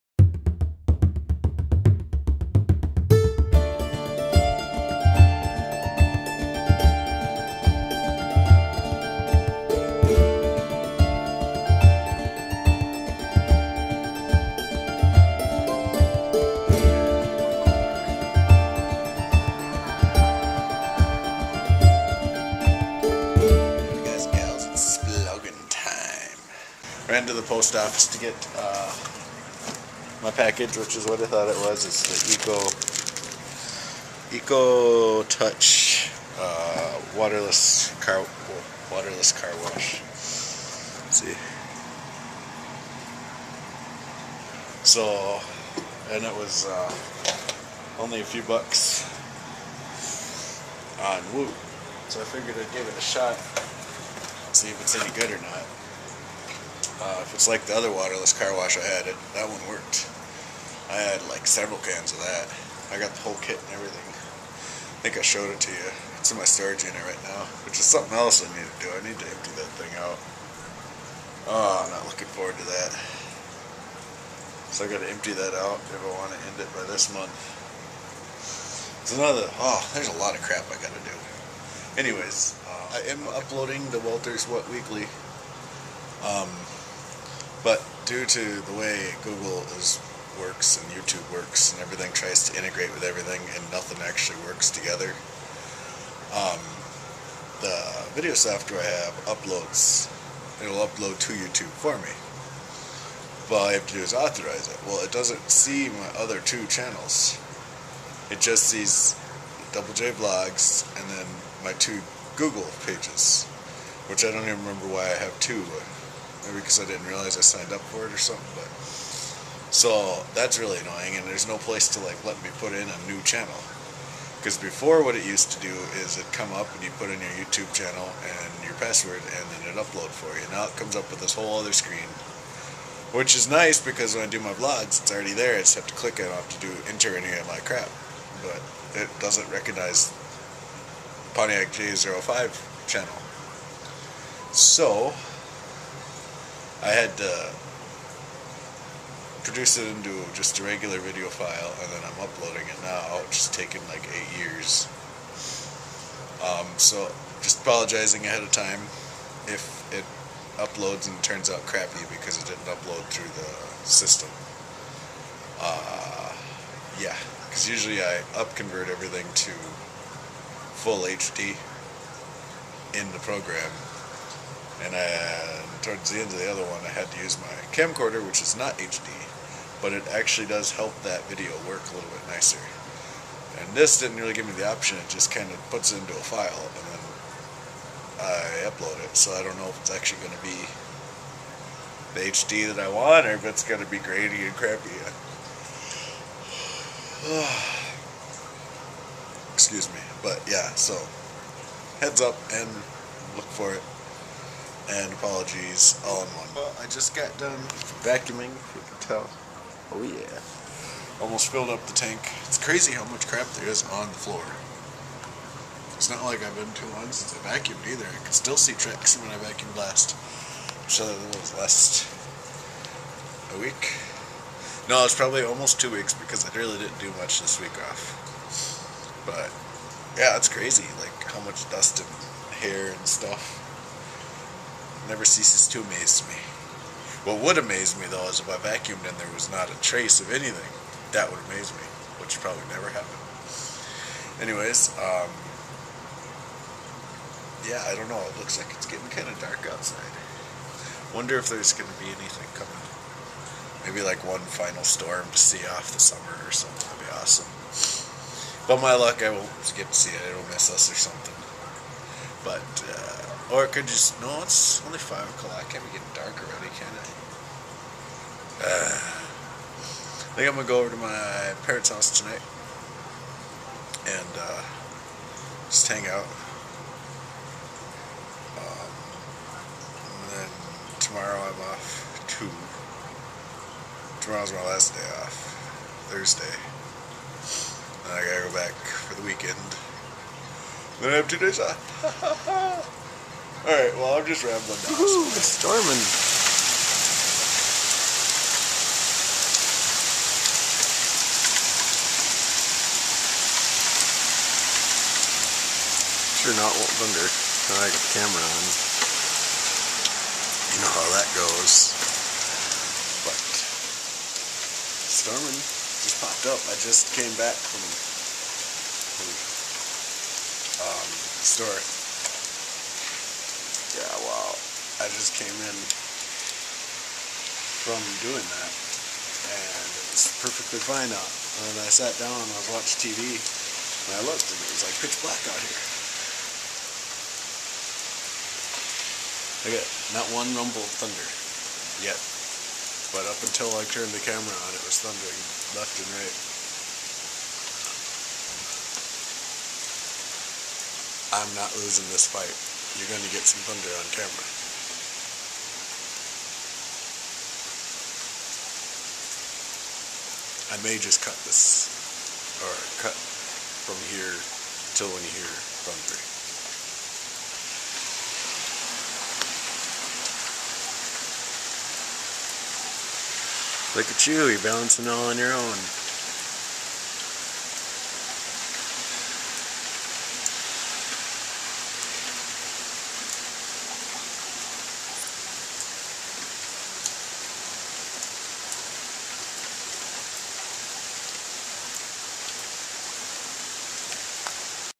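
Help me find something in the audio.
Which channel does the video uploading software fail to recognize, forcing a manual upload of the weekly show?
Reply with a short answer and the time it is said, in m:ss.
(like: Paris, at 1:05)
Pontiac GA05, at 2:21.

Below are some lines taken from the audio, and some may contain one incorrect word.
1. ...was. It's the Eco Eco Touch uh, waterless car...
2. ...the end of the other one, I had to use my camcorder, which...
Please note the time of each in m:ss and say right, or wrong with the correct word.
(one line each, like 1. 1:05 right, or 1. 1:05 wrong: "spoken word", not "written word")
1. 0:31 right
2. 2:56 right.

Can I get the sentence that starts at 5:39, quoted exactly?
I got not one rumble of thunder yet.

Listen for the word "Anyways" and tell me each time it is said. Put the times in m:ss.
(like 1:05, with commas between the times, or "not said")
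1:21, 4:04.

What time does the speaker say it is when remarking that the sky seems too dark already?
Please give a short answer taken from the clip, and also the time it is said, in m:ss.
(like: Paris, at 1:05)
5 o'clock, at 4:24.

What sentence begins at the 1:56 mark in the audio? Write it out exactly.
Maybe because I didn't realize I signed up for it or something.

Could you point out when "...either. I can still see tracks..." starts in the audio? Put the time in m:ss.
3:37.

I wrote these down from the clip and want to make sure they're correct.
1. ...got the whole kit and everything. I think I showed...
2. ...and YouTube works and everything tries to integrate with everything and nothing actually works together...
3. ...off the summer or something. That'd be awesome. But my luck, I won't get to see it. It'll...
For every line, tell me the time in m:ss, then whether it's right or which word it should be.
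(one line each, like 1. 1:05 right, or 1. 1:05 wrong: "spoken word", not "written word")
1. 1:03 right
2. 1:30 right
3. 4:15 right.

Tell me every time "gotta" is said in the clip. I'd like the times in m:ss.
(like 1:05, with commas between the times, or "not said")
1:14, 1:20, 4:48.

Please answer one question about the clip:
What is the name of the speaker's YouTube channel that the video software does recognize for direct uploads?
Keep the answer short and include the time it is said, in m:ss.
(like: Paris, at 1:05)
Double J Vlogs, at 1:49.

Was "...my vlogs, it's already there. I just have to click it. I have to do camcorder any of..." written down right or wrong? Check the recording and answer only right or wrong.
wrong.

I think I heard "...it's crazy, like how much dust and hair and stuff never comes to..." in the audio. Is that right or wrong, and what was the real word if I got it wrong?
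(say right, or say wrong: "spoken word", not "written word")
wrong: "ceases", not "comes".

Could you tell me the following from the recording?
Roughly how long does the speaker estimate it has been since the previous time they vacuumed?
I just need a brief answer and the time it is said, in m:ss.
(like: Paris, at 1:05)
almost 2 weeks, at 3:45.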